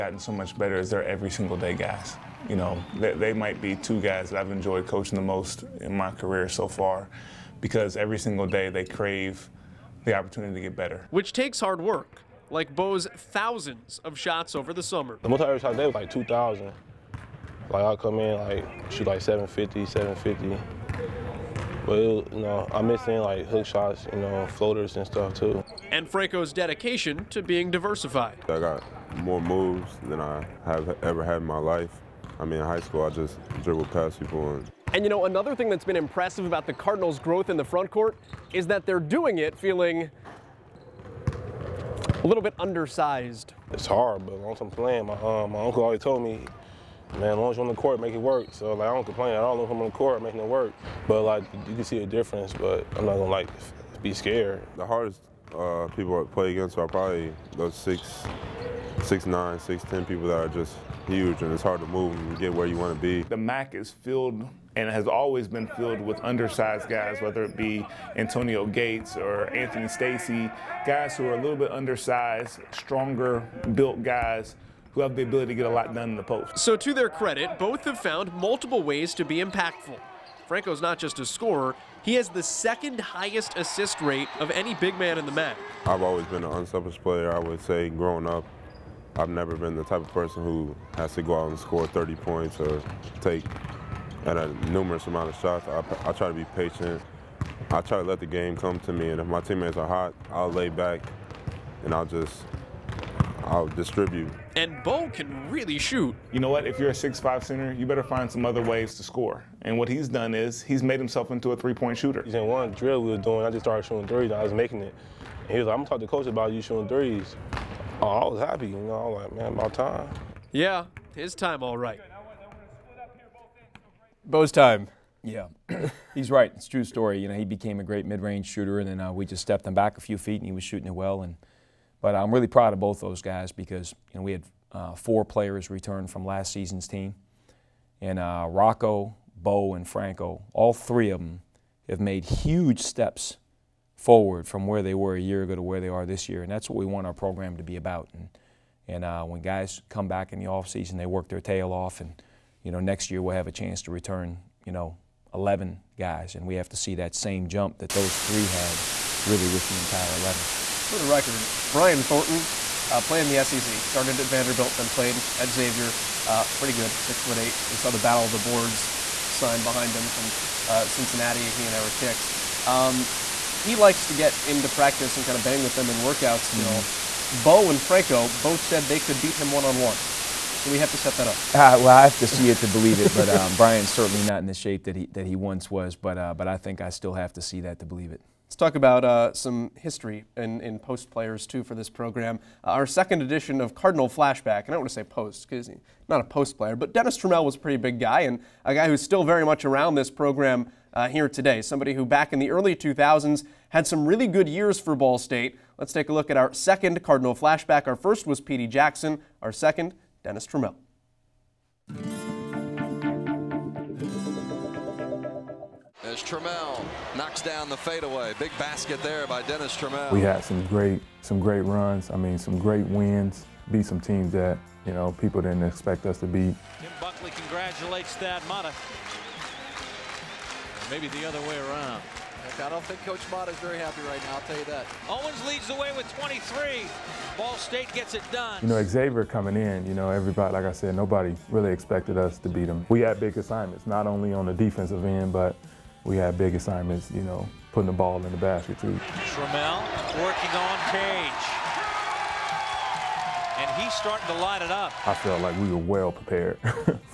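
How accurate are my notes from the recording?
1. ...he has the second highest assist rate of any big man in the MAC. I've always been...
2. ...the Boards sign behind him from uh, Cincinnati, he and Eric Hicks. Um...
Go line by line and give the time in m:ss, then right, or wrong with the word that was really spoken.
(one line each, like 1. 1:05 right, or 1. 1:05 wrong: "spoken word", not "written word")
1. 1:22 right
2. 2:48 right.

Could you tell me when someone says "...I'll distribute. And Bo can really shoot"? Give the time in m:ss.
1:43.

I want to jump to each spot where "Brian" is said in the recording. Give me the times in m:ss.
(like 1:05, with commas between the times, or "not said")
2:41, 3:03.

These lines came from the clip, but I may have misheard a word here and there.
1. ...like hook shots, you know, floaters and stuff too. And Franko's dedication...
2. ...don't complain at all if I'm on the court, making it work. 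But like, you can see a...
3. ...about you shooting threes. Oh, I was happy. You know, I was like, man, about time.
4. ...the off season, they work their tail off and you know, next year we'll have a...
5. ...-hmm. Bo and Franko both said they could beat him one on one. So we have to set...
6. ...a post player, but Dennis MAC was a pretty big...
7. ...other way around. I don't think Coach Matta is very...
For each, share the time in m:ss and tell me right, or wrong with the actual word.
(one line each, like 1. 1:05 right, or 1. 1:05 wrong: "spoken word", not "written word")
1. 0:23 right
2. 0:48 right
3. 1:56 right
4. 2:30 right
5. 2:56 right
6. 3:16 wrong: "Trammell", not "MAC"
7. 3:51 right.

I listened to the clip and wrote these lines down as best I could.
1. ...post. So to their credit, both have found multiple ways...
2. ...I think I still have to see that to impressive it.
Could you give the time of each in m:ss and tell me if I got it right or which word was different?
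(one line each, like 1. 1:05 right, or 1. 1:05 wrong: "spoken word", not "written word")
1. 1:16 right
2. 3:06 wrong: "believe", not "impressive".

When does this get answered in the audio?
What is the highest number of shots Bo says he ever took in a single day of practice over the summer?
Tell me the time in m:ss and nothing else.
0:16.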